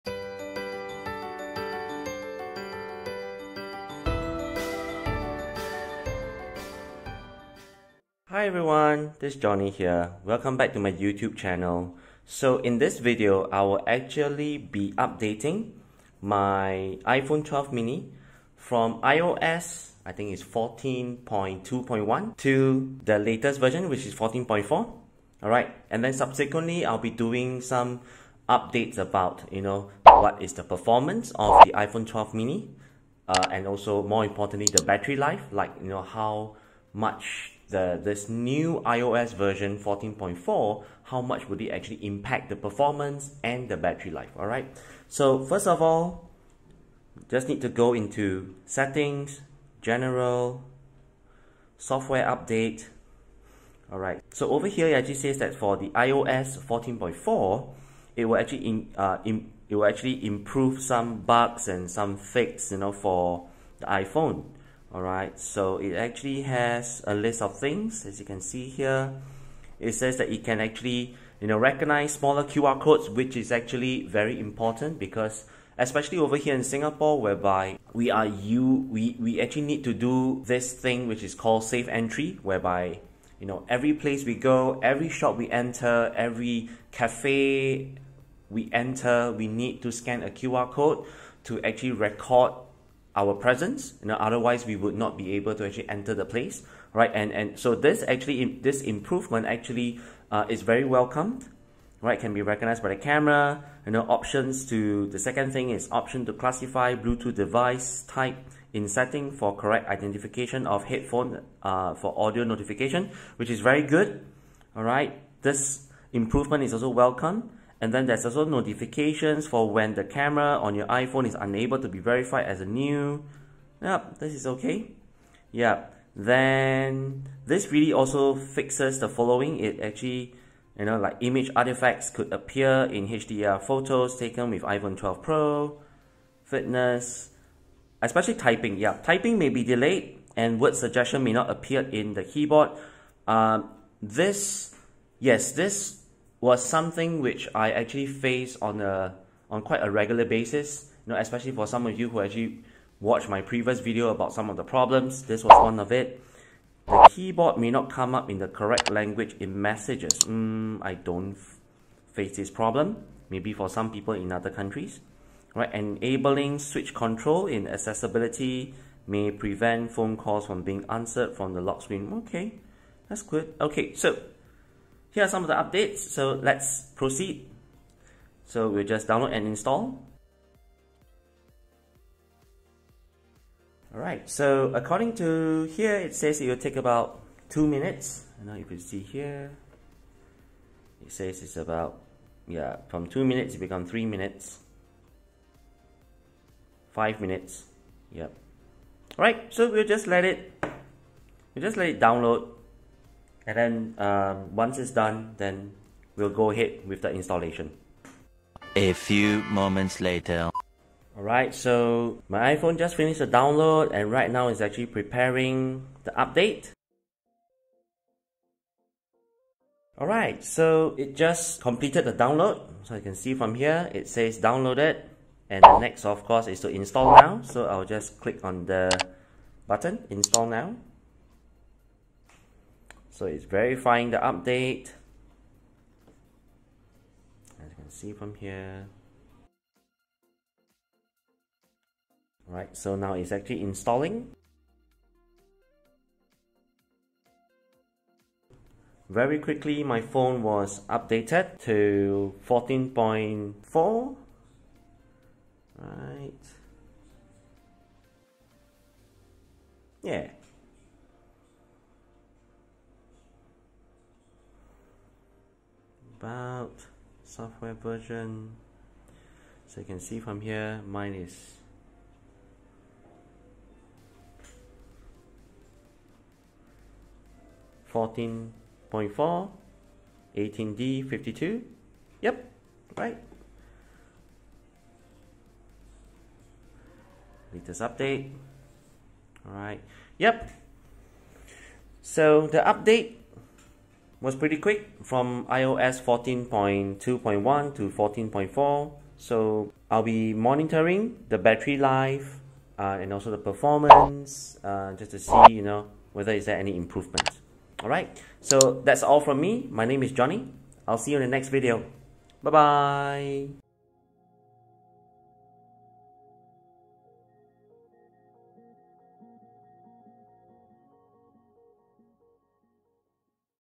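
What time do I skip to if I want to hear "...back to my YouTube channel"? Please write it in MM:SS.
00:10.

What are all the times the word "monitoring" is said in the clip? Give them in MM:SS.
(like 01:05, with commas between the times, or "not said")
05:00.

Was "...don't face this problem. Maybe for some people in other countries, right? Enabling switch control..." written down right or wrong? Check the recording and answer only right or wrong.
right.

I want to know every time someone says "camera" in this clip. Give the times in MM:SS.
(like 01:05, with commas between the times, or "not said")
01:43, 02:00.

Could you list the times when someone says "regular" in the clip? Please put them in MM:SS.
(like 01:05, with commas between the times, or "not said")
02:29.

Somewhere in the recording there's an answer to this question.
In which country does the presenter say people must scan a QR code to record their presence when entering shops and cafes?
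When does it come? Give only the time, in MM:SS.
01:16.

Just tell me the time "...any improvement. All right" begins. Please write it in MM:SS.
05:06.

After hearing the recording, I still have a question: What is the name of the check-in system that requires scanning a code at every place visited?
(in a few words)
Safe entry.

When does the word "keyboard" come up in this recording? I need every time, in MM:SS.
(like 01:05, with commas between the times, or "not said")
02:22, 02:37.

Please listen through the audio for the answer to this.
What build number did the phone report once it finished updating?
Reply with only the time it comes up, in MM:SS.
04:40.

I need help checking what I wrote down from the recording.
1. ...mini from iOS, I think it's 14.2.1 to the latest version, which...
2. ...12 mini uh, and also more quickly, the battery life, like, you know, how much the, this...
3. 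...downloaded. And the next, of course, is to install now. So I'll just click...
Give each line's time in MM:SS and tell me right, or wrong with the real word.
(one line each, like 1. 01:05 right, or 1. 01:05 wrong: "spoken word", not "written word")
1. 00:17 right
2. 00:32 wrong: "importantly", not "quickly"
3. 03:44 right.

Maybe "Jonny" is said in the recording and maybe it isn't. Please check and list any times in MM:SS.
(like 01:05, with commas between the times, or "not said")
00:09, 05:10.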